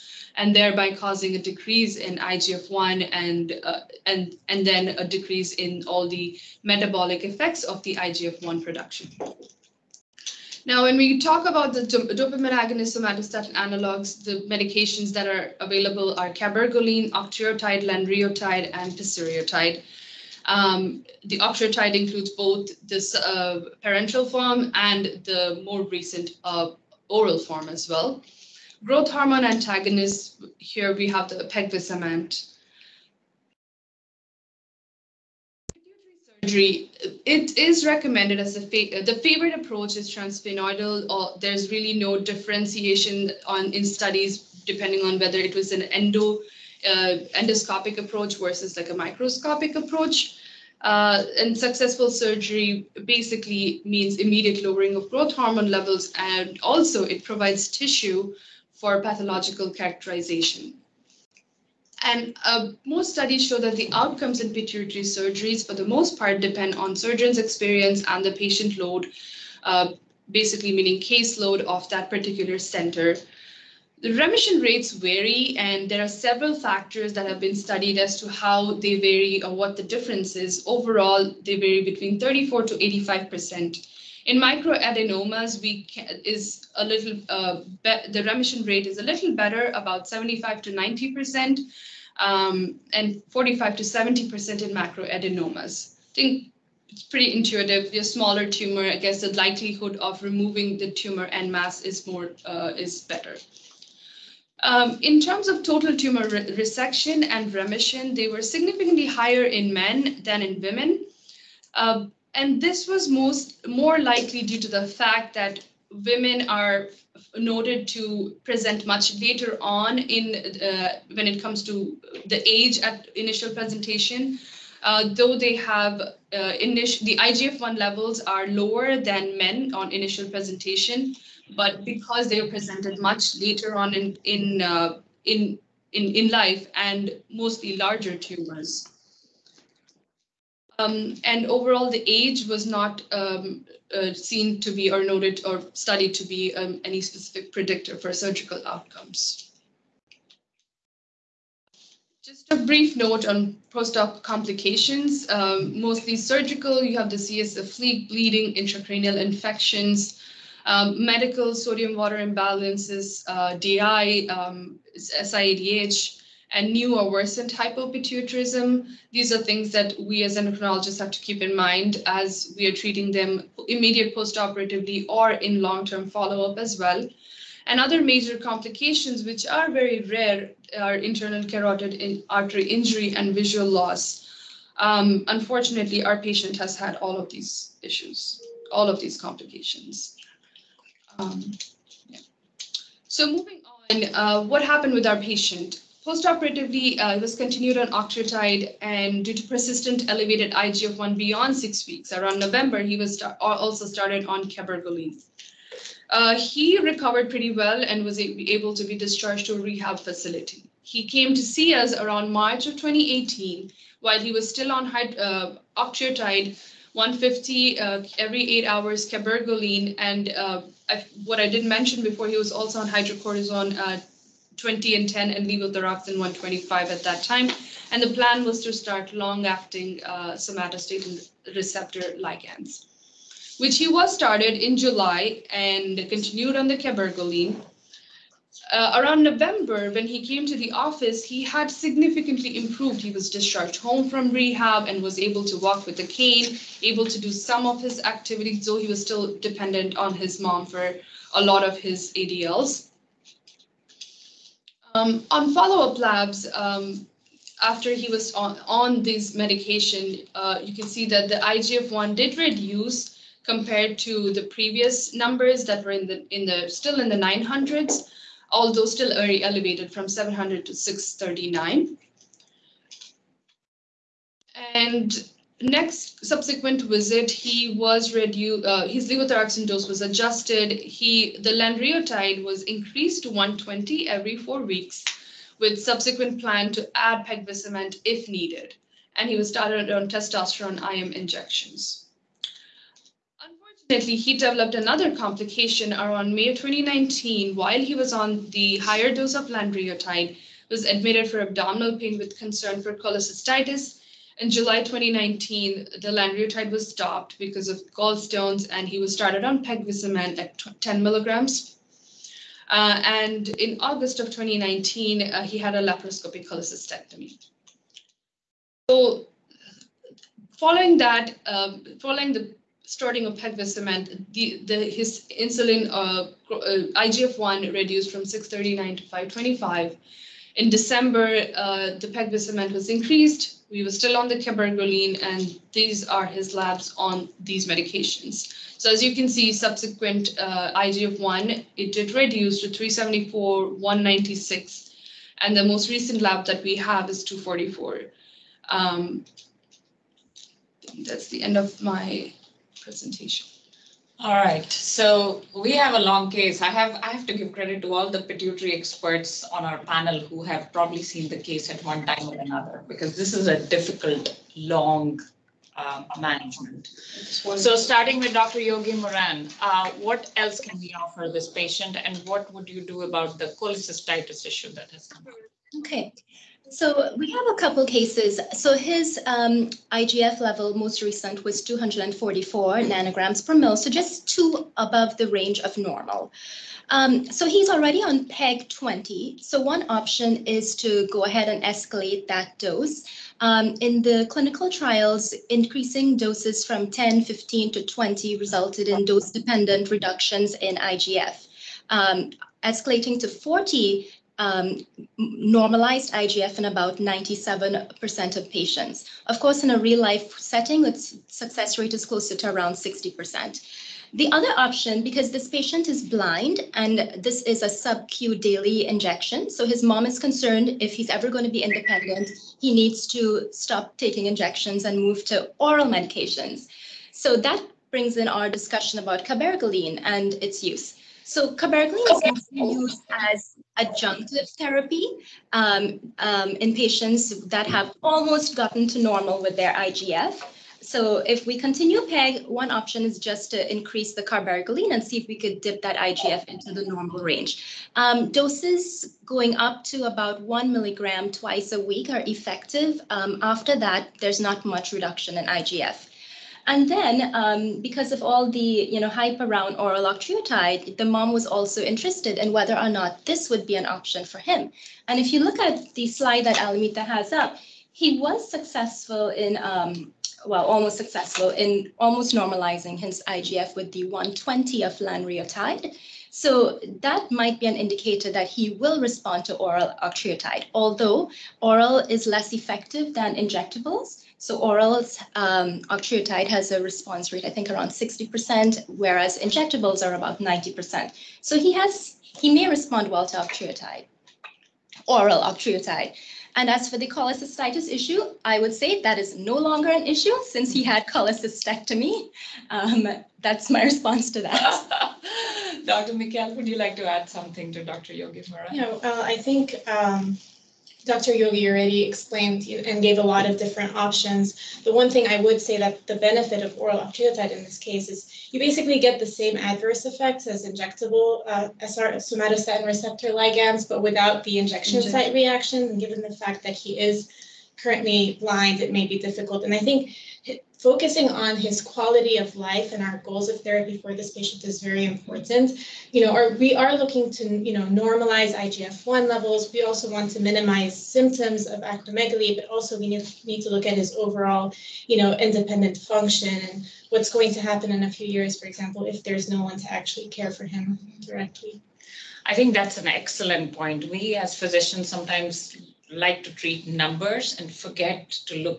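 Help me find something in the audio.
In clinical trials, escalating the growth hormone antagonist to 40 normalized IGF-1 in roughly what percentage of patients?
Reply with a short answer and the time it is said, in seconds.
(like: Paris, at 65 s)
97%, at 406 s.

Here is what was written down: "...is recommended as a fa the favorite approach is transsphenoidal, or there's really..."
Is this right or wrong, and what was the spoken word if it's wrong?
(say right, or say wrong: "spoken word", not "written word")
right.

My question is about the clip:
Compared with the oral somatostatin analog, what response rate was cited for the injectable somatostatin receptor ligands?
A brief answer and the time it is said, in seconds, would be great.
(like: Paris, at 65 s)
About 90%, at 490 s.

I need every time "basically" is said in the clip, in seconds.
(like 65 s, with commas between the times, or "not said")
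53 s, 70 s, 518 s.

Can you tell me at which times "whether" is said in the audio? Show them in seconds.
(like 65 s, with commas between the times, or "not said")
45 s, 462 s.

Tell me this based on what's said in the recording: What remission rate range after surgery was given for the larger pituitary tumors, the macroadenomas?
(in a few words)
45 to 70%.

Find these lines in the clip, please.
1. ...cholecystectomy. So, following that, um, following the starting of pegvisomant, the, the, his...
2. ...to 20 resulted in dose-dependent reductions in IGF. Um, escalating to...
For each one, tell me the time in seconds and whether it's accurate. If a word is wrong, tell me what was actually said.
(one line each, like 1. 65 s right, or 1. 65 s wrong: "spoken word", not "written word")
1. 316 s right
2. 397 s right.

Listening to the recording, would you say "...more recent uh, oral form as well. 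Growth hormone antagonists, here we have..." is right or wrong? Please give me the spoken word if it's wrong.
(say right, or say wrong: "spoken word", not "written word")
right.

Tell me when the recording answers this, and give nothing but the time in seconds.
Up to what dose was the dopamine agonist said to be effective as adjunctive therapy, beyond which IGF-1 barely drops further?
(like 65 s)
450 s.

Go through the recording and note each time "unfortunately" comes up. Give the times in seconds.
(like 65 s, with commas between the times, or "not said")
185 s, 293 s.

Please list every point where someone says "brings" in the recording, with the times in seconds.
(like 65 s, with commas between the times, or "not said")
427 s.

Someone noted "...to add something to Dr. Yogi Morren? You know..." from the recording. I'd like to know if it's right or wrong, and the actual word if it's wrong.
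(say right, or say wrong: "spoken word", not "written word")
right.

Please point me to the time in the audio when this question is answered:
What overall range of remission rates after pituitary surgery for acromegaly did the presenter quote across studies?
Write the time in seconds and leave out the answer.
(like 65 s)
82 s.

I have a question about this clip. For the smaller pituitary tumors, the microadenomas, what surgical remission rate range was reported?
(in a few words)
75 to 90%.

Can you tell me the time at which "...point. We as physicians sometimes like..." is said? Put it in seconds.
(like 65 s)
553 s.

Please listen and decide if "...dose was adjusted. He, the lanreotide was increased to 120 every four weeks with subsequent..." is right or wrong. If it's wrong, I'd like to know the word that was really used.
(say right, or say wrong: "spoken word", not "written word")
right.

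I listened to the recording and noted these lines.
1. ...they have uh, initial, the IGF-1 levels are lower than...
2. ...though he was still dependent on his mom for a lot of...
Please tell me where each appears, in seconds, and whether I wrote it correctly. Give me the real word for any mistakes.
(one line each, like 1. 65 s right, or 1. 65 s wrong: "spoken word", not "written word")
1. 125 s right
2. 248 s right.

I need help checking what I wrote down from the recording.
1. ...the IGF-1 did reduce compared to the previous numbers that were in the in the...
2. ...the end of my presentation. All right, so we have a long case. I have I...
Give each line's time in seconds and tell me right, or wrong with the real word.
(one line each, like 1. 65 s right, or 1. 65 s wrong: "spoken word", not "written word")
1. 261 s right
2. 351 s right.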